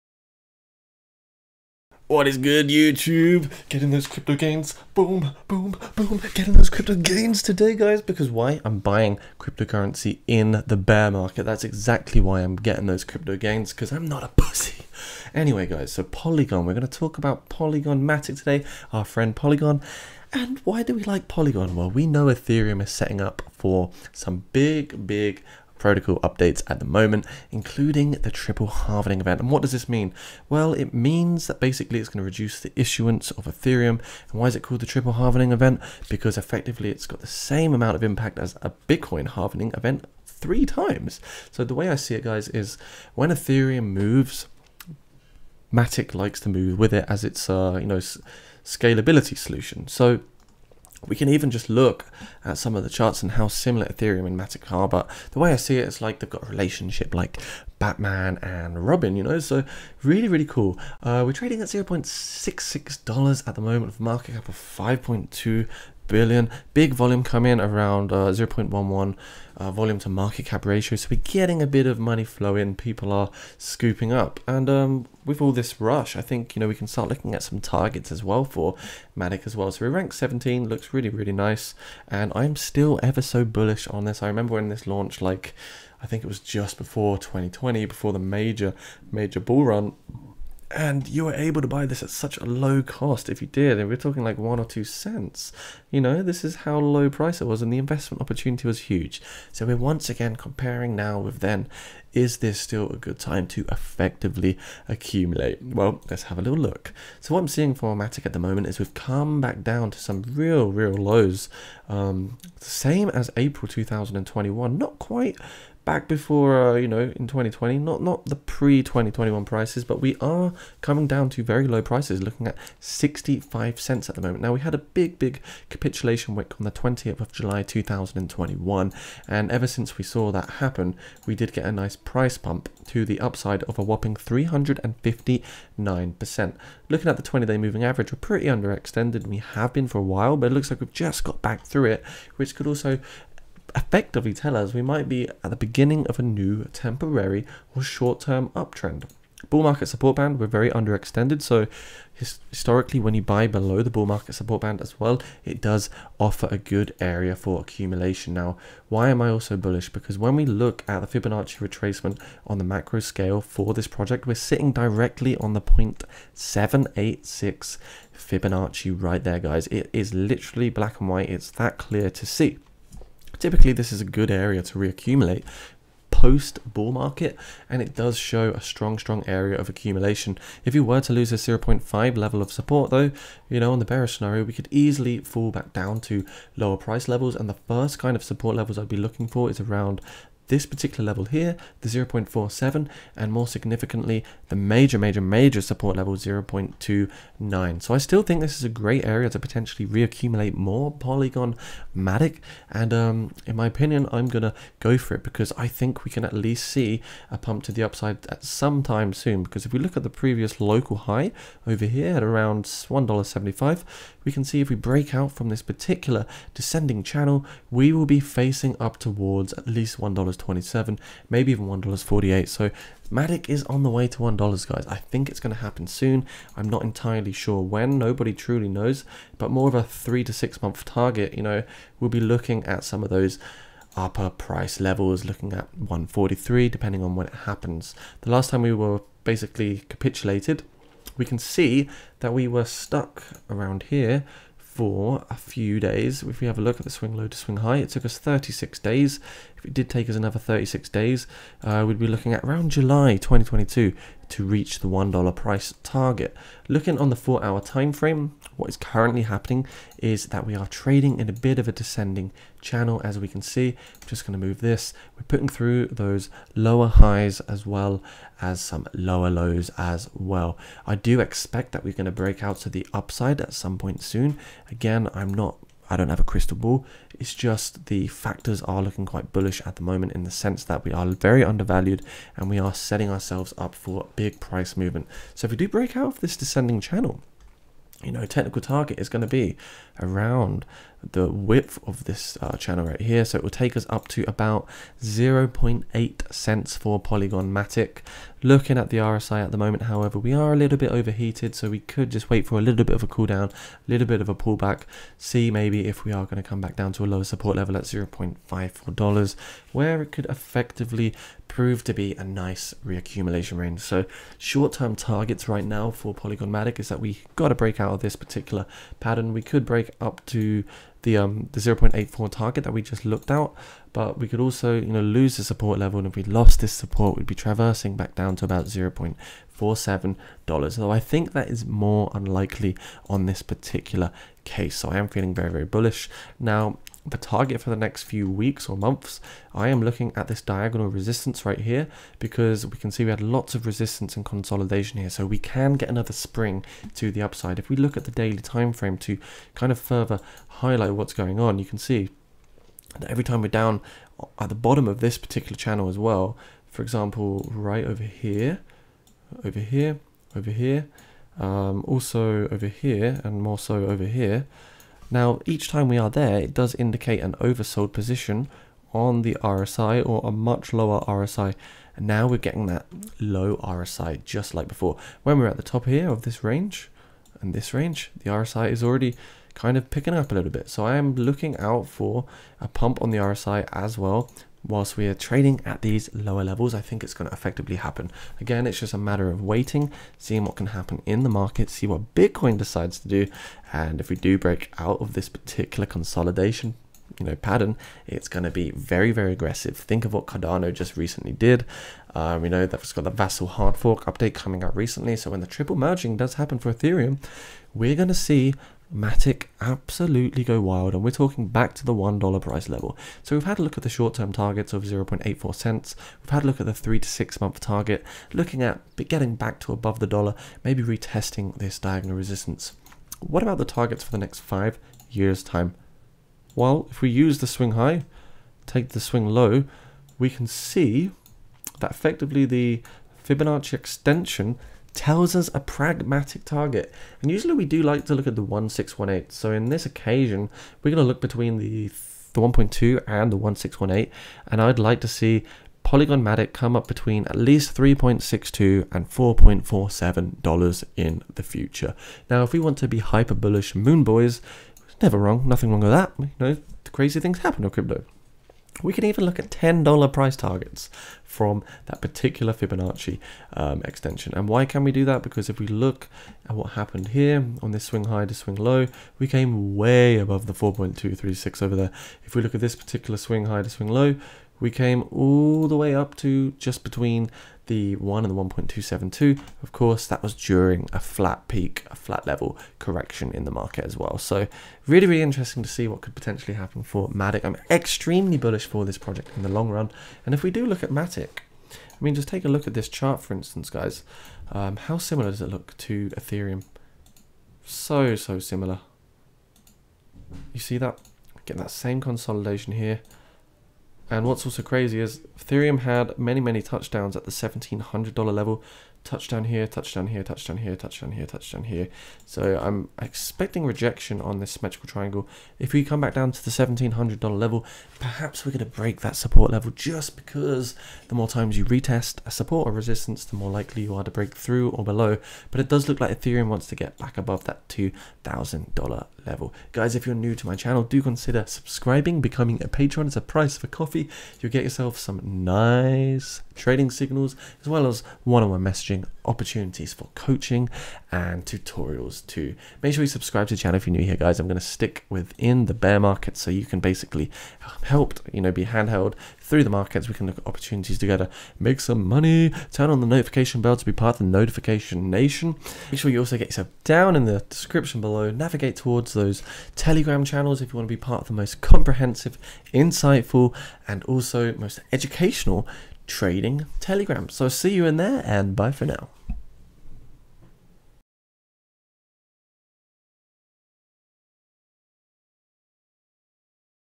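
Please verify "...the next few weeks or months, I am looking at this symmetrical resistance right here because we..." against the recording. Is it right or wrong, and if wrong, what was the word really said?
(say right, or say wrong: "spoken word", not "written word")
wrong: "diagonal", not "symmetrical".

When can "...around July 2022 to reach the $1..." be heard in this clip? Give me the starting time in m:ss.
4:12.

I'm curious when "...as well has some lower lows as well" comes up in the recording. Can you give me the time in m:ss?
4:27.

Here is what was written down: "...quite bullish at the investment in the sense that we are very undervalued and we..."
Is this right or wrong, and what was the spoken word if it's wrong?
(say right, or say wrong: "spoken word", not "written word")
wrong: "moment", not "investment".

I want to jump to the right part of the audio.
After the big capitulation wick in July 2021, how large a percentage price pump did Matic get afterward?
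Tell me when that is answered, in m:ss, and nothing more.
2:14.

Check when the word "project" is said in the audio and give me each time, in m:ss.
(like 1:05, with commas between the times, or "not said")
2:43, 8:08.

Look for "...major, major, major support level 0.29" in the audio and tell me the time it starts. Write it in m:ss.
3:14.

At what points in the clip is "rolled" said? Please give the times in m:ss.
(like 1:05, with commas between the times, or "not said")
not said.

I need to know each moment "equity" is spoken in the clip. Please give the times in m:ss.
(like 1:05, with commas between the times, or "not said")
not said.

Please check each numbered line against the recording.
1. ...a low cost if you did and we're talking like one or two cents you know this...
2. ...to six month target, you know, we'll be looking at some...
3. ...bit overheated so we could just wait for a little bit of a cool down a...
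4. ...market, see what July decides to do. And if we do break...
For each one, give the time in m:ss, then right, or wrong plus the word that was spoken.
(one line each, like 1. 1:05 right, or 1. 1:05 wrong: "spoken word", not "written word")
1. 1:32 right
2. 3:50 right
3. 5:00 right
4. 6:31 wrong: "Bitcoin", not "July".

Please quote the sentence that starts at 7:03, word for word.
What about the targets for the next 5 years time?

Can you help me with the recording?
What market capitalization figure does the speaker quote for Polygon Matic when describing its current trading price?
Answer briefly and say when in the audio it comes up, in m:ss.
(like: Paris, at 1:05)
5.2 billion, at 1:04.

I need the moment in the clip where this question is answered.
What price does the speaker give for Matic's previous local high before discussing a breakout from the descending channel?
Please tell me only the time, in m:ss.
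3:32.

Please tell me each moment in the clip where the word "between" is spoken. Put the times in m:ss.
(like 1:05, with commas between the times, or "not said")
7:21, 7:26, 7:56.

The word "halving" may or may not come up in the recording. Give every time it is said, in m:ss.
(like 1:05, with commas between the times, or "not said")
0:28, 0:35, 0:39.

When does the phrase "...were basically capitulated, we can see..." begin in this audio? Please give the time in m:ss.
3:58.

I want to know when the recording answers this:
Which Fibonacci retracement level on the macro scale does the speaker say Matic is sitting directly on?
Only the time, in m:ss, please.
2:45.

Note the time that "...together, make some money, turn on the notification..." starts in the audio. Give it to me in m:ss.
9:10.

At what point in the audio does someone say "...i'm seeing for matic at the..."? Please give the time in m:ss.
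1:47.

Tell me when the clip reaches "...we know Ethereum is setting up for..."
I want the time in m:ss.
0:21.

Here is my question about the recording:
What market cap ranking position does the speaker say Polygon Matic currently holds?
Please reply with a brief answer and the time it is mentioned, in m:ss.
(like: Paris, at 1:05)
17, at 1:19.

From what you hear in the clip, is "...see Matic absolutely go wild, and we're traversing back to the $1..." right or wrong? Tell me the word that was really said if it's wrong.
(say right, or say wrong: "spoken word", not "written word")
wrong: "talking", not "traversing".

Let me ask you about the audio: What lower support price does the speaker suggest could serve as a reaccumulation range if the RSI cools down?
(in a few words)
$0.54.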